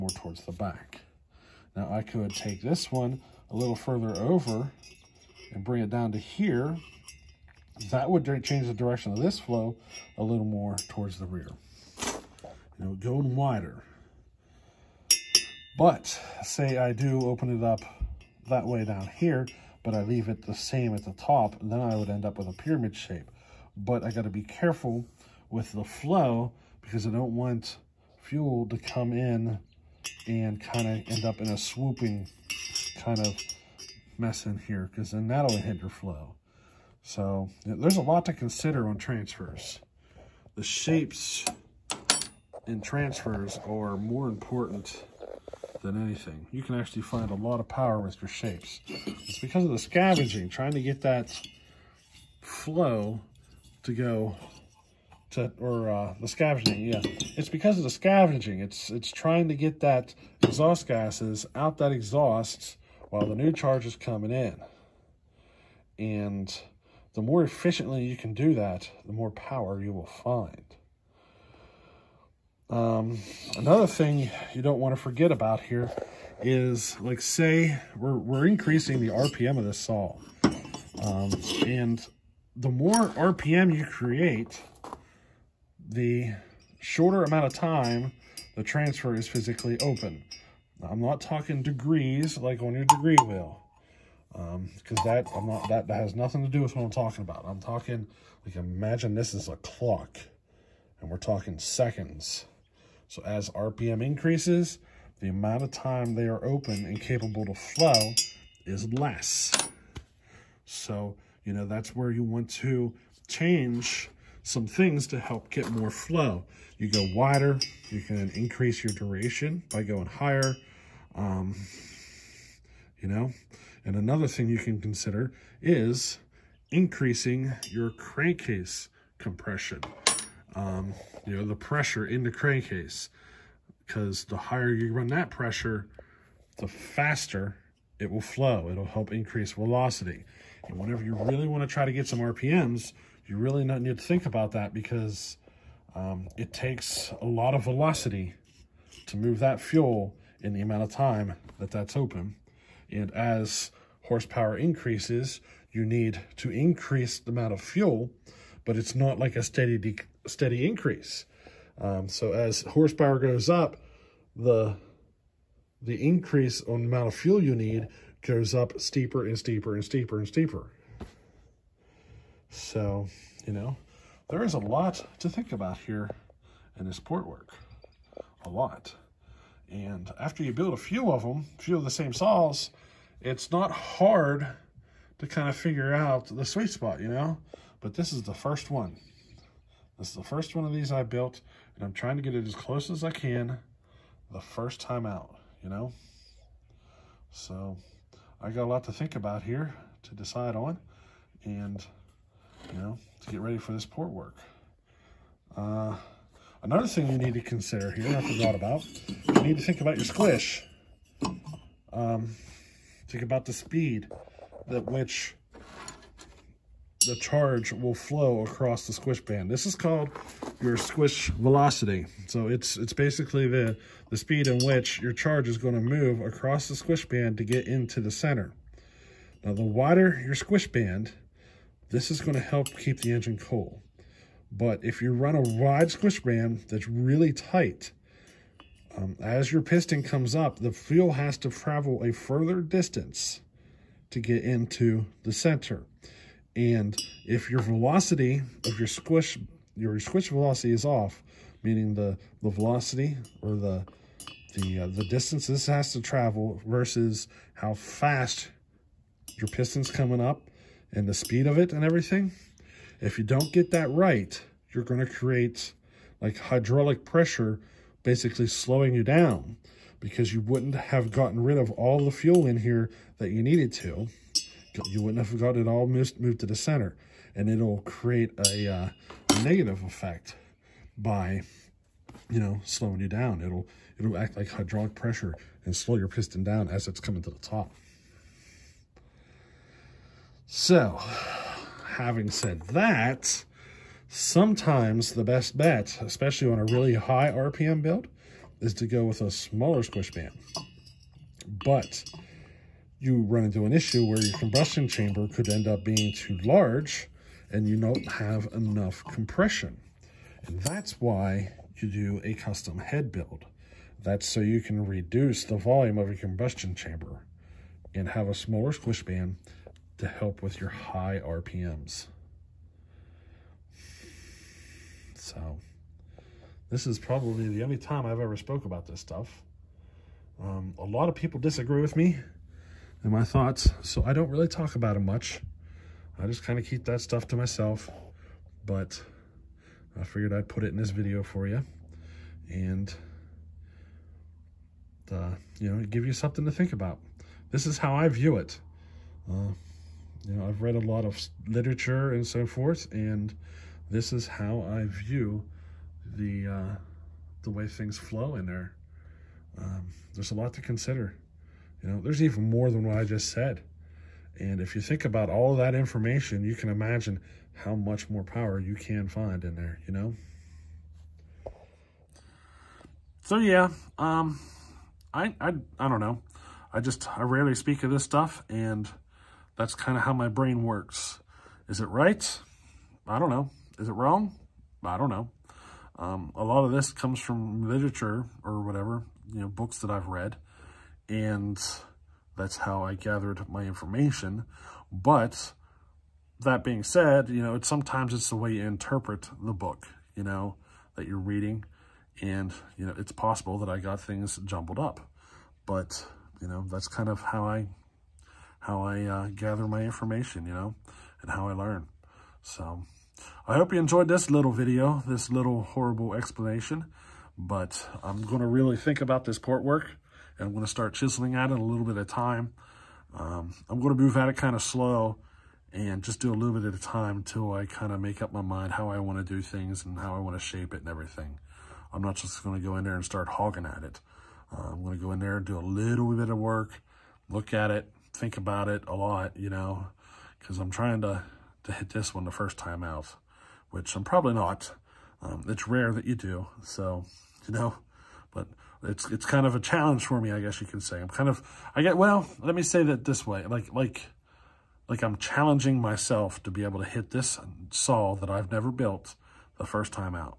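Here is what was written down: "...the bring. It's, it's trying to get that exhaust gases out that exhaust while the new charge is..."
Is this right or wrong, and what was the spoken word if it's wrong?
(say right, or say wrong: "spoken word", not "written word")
wrong: "scavenging", not "bring".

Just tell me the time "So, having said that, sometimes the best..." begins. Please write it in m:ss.
4:50.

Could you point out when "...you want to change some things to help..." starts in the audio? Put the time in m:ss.
1:52.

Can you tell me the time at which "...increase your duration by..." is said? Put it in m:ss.
1:58.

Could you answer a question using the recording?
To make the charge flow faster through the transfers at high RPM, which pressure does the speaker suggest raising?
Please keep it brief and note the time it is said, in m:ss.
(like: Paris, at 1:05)
crankcase compression, at 2:07.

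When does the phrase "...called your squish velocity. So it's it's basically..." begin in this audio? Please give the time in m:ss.
3:39.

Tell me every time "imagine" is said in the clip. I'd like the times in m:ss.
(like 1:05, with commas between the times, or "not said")
1:38, 6:06.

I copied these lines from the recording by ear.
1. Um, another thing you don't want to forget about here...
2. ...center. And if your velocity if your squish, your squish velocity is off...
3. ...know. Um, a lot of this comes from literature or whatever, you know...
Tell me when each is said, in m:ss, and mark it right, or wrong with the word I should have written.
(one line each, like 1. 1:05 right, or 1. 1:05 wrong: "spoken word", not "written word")
1. 1:12 right
2. 4:05 right
3. 6:25 right.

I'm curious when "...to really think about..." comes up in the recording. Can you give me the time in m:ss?
6:58.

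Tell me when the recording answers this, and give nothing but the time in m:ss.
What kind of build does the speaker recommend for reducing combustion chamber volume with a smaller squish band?
5:12.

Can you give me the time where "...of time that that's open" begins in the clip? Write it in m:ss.
2:30.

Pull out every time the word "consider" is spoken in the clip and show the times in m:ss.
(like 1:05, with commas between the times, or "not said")
0:38, 2:04, 3:27, 6:00.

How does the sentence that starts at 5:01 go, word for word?
But you run into an issue where your combustion chamber could end up being too large and you don't have enough compression.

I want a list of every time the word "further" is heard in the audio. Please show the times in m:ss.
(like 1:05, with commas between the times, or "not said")
0:03, 4:02.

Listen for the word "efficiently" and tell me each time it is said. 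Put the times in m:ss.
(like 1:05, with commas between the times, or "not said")
1:07.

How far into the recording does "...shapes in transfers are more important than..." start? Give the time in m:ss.
0:40.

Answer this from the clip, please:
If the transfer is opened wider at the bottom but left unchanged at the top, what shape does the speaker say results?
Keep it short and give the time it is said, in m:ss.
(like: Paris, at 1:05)
pyramid shape, at 0:22.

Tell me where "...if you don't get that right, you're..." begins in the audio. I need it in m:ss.
4:22.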